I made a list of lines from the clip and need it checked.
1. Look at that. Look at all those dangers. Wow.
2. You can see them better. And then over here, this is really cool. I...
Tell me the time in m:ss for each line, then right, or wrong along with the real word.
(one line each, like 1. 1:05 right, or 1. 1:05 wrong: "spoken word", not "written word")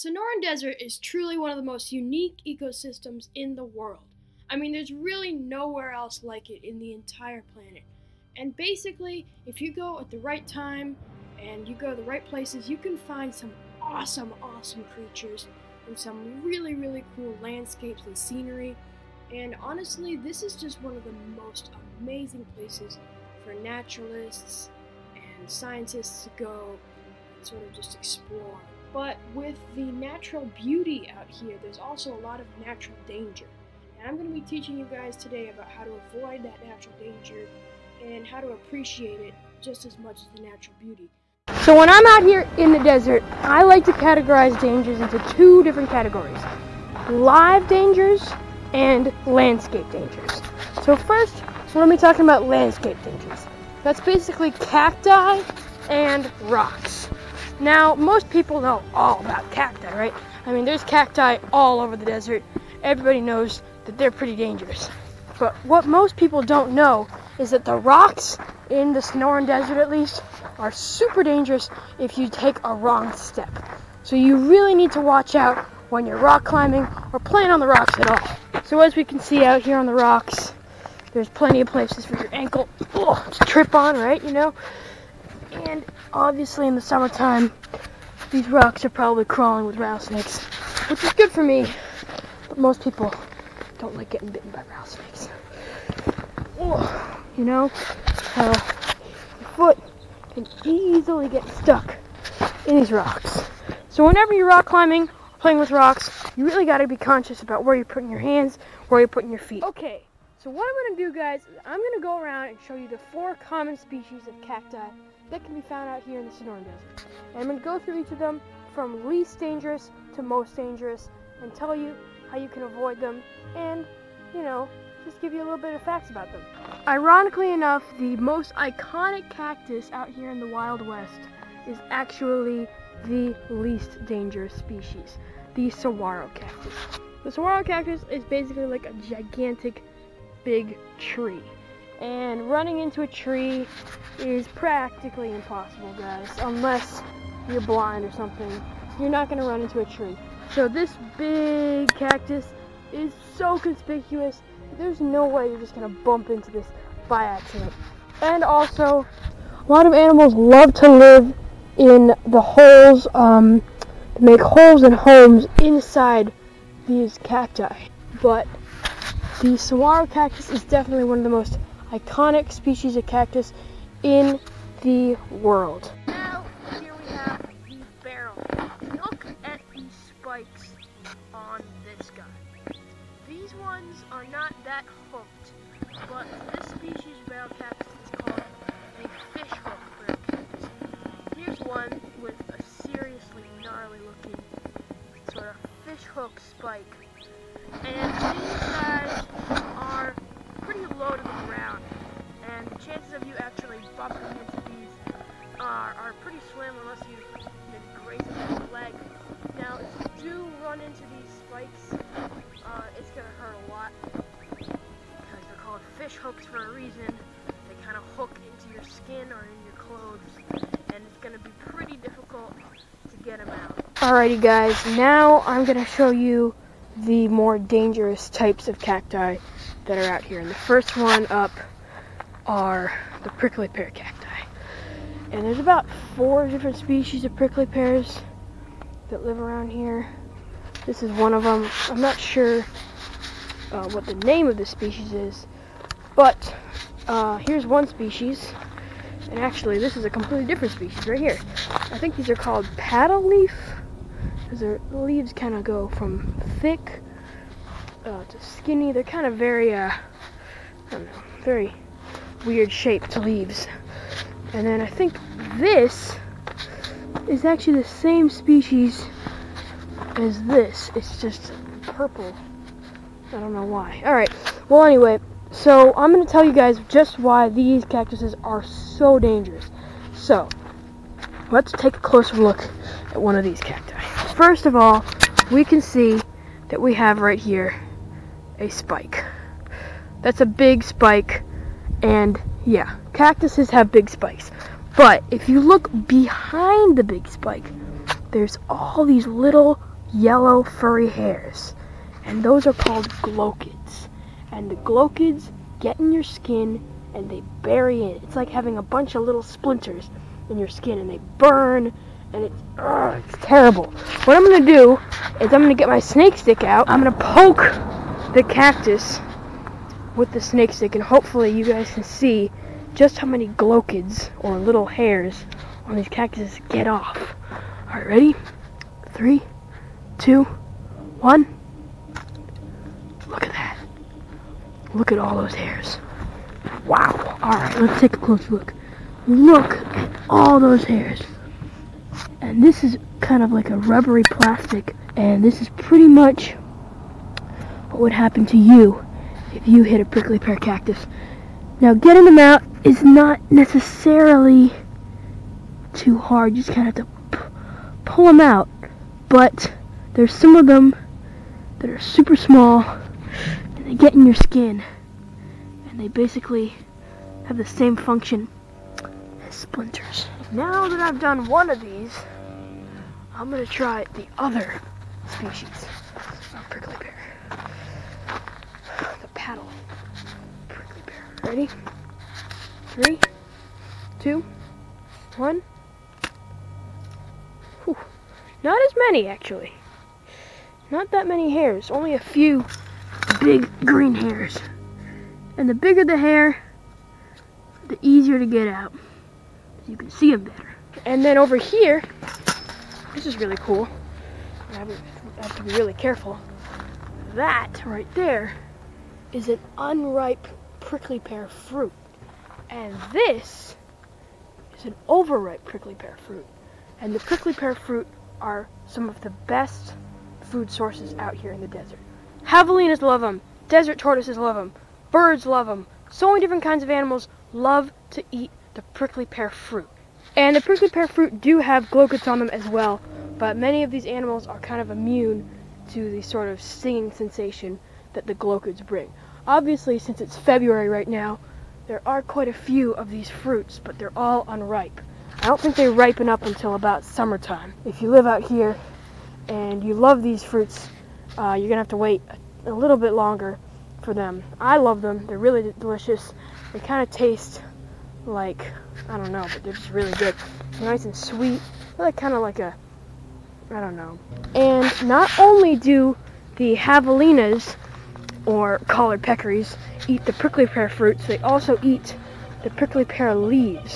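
1. 5:33 wrong: "hairs", not "dangers"
2. 6:39 right.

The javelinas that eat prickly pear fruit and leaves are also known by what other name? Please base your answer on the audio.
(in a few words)
Collared peccaries.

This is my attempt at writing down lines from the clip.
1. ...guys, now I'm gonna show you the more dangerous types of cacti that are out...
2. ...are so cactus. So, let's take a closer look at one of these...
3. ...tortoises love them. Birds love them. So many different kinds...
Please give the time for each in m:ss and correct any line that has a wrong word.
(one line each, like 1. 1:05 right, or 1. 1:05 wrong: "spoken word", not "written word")
1. 3:44 right
2. 4:38 wrong: "dangerous", not "cactus"
3. 7:03 right.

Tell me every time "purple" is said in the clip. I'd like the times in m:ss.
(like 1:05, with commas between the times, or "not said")
4:31.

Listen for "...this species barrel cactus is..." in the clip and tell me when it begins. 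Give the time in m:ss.
3:06.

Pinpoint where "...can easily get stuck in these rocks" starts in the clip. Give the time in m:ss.
1:40.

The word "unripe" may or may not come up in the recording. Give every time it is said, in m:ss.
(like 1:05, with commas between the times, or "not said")
6:49, 7:24.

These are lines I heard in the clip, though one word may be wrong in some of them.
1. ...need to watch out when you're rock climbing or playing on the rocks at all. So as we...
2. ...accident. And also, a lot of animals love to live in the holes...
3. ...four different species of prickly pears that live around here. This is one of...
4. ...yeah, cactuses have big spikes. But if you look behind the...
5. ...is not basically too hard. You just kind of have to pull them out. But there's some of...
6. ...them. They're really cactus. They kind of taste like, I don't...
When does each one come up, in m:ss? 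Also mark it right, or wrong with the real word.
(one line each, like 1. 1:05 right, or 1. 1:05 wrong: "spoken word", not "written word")
1. 1:14 right
2. 2:37 right
3. 3:56 right
4. 4:52 right
5. 5:52 wrong: "necessarily", not "basically"
6. 7:35 wrong: "delicious", not "cactus".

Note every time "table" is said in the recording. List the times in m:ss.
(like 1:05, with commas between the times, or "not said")
not said.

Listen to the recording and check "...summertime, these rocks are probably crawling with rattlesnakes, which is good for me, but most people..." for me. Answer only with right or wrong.
right.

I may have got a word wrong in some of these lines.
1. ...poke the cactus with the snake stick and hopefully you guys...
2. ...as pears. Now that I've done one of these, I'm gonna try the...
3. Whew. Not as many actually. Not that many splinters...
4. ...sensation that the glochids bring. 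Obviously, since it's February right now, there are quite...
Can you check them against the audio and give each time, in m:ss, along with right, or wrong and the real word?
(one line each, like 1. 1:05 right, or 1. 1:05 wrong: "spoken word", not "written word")
1. 5:17 right
2. 6:09 wrong: "splinters", not "pears"
3. 6:27 wrong: "hairs", not "splinters"
4. 7:17 right.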